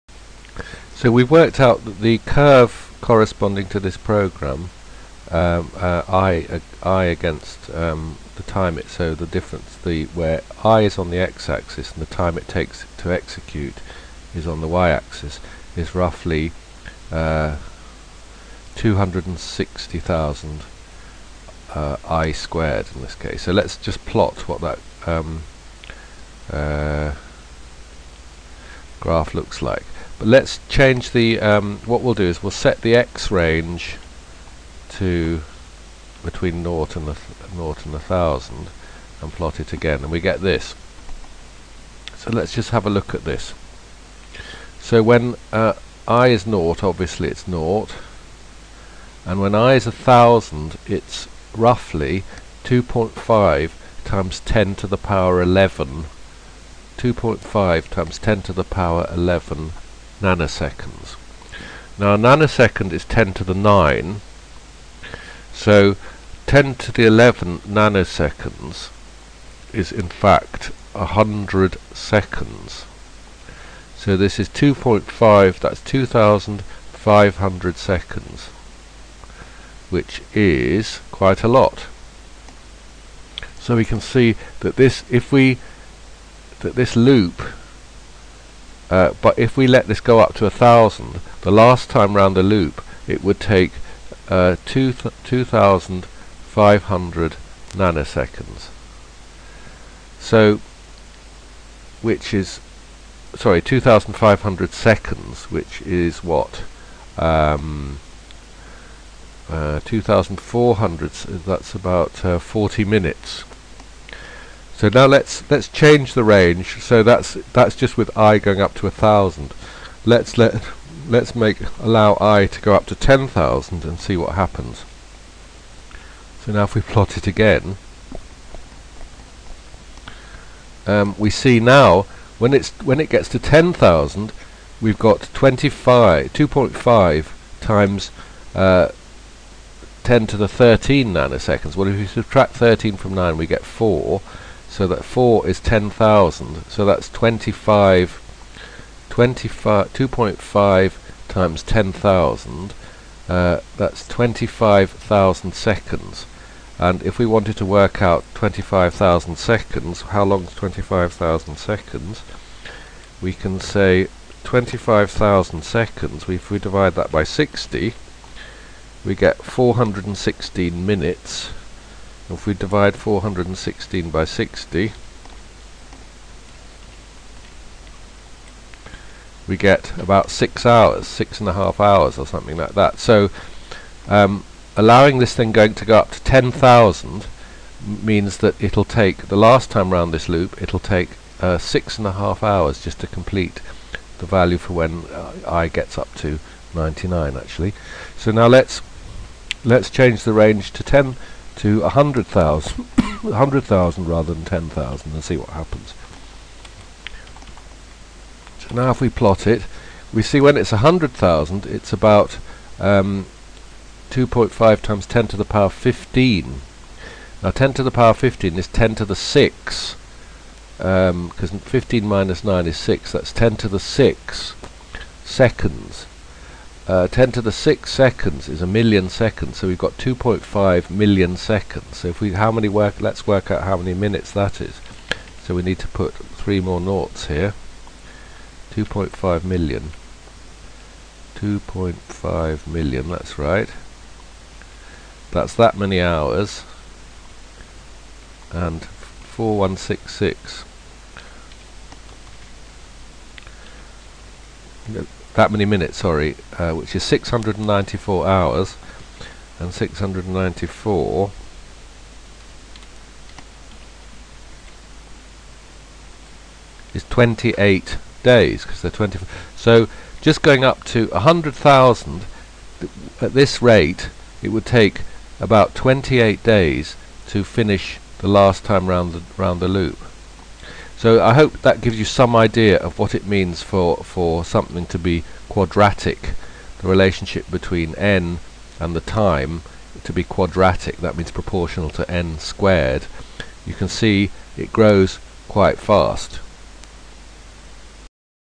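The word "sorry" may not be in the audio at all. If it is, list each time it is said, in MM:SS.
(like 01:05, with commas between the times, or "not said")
01:43, 04:15.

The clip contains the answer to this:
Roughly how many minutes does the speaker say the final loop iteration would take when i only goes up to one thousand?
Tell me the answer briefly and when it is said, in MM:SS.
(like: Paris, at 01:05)
40 minutes, at 01:52.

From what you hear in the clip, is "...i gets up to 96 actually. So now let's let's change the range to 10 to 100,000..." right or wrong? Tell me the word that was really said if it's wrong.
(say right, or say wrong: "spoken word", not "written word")
wrong: "99", not "96".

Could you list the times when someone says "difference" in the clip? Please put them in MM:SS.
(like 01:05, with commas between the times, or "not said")
00:09.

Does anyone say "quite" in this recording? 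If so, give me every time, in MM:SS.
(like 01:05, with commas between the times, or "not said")
01:21, 04:55.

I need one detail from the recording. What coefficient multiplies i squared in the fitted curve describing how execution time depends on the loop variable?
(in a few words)
260,000.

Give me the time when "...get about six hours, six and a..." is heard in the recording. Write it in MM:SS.
02:59.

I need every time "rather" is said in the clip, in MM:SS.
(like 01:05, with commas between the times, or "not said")
03:24.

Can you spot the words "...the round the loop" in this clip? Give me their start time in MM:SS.
04:39.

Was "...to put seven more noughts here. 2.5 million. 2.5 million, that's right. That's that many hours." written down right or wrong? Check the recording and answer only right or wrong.
wrong.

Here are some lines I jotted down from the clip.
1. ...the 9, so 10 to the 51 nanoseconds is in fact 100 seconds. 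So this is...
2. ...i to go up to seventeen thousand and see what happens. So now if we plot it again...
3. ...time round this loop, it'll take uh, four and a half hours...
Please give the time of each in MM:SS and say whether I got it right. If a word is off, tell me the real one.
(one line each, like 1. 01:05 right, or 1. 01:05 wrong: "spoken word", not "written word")
1. 01:03 wrong: "11", not "51"
2. 02:02 wrong: "ten", not "seventeen"
3. 03:09 wrong: "six", not "four".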